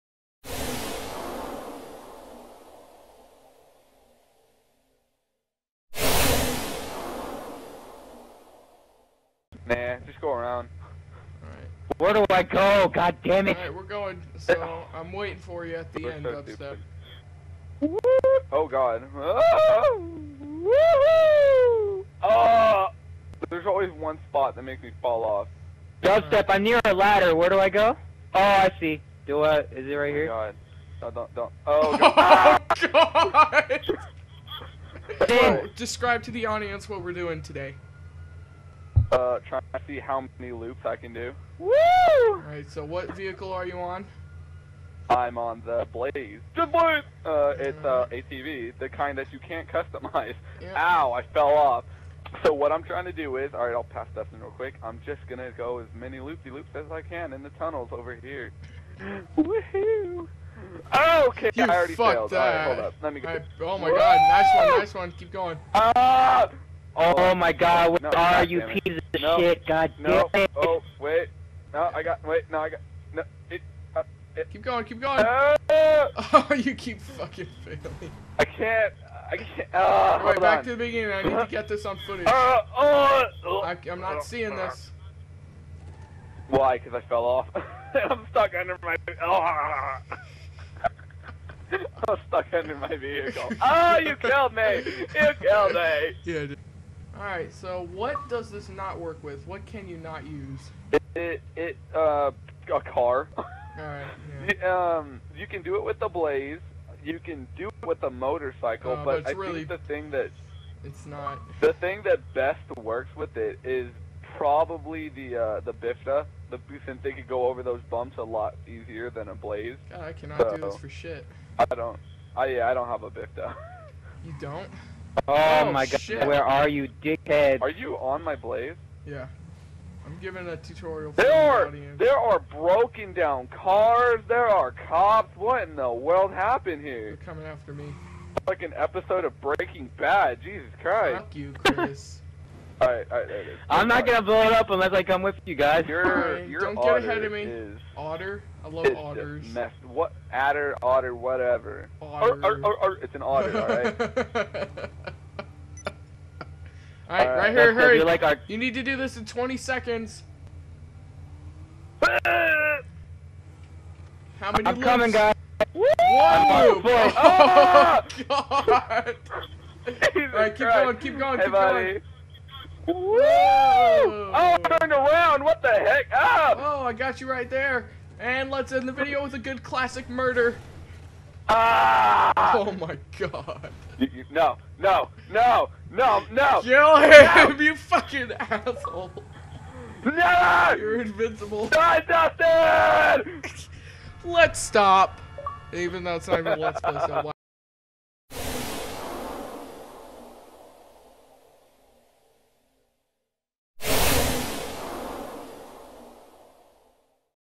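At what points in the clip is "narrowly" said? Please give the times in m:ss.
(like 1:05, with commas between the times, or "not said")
not said.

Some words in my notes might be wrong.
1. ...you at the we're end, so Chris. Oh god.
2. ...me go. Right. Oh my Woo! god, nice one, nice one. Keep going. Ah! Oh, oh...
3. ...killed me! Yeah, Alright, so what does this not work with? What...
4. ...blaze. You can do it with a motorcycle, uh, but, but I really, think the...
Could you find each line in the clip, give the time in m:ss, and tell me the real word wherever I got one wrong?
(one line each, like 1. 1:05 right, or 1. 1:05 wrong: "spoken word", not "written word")
1. 0:15 wrong: "Dubstep", not "Chris"
2. 1:03 right
3. 1:35 right
4. 1:46 right.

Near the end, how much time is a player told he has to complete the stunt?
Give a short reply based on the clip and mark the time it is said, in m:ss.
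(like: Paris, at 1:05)
20 seconds, at 2:39.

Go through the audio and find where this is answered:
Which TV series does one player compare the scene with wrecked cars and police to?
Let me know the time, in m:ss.
2:19.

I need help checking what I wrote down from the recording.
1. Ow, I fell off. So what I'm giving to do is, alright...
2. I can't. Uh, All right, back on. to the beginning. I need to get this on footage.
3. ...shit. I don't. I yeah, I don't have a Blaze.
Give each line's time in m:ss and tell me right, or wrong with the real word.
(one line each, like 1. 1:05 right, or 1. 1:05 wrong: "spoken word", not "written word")
1. 0:50 wrong: "trying", not "giving"
2. 1:19 right
3. 2:00 wrong: "Bifta", not "Blaze".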